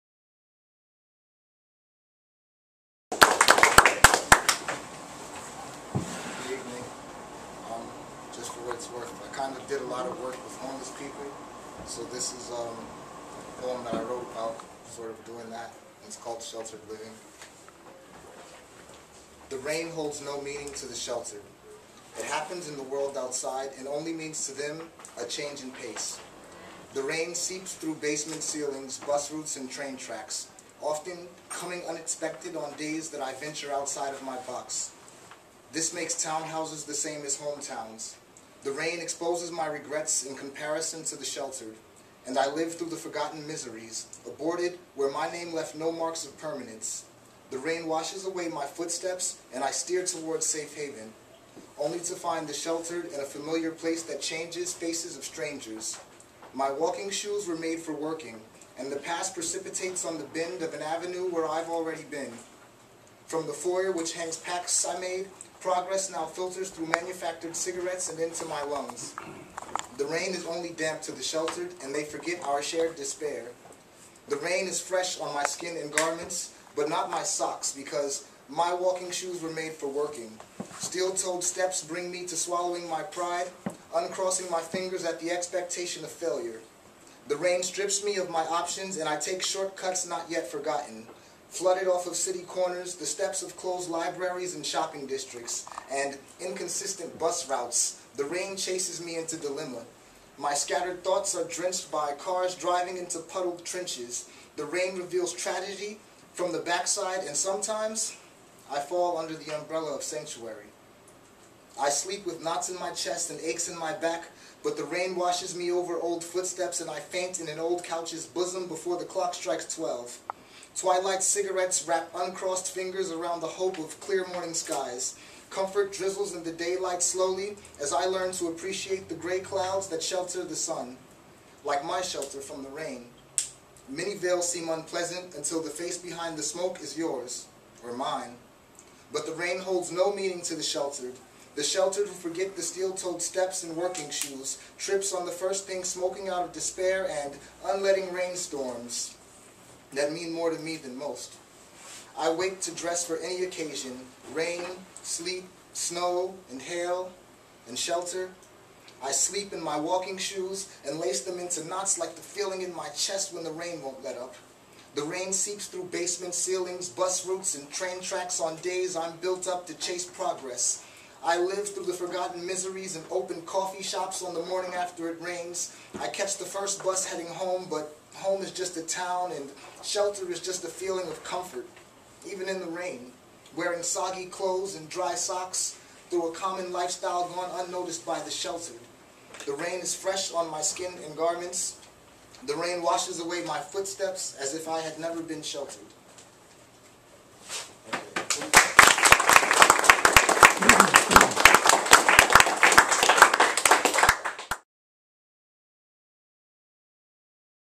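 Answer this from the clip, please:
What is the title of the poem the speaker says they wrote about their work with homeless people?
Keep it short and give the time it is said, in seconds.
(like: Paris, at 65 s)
Sheltered Living, at 16 s.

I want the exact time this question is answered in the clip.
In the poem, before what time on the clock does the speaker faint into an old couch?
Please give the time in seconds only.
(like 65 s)
119 s.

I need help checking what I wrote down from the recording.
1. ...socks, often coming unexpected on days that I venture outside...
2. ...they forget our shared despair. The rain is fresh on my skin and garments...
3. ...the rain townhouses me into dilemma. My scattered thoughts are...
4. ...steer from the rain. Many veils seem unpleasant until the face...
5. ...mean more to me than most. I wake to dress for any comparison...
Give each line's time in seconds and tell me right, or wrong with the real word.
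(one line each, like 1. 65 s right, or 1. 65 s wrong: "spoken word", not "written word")
1. 29 s wrong: "tracks", not "socks"
2. 71 s right
3. 98 s wrong: "chases", not "townhouses"
4. 132 s wrong: "shelter", not "steer"
5. 150 s wrong: "occasion", not "comparison".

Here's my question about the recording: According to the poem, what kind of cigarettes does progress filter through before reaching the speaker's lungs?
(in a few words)
manufactured.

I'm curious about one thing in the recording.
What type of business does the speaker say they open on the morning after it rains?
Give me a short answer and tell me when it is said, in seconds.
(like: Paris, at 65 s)
coffee shops, at 173 s.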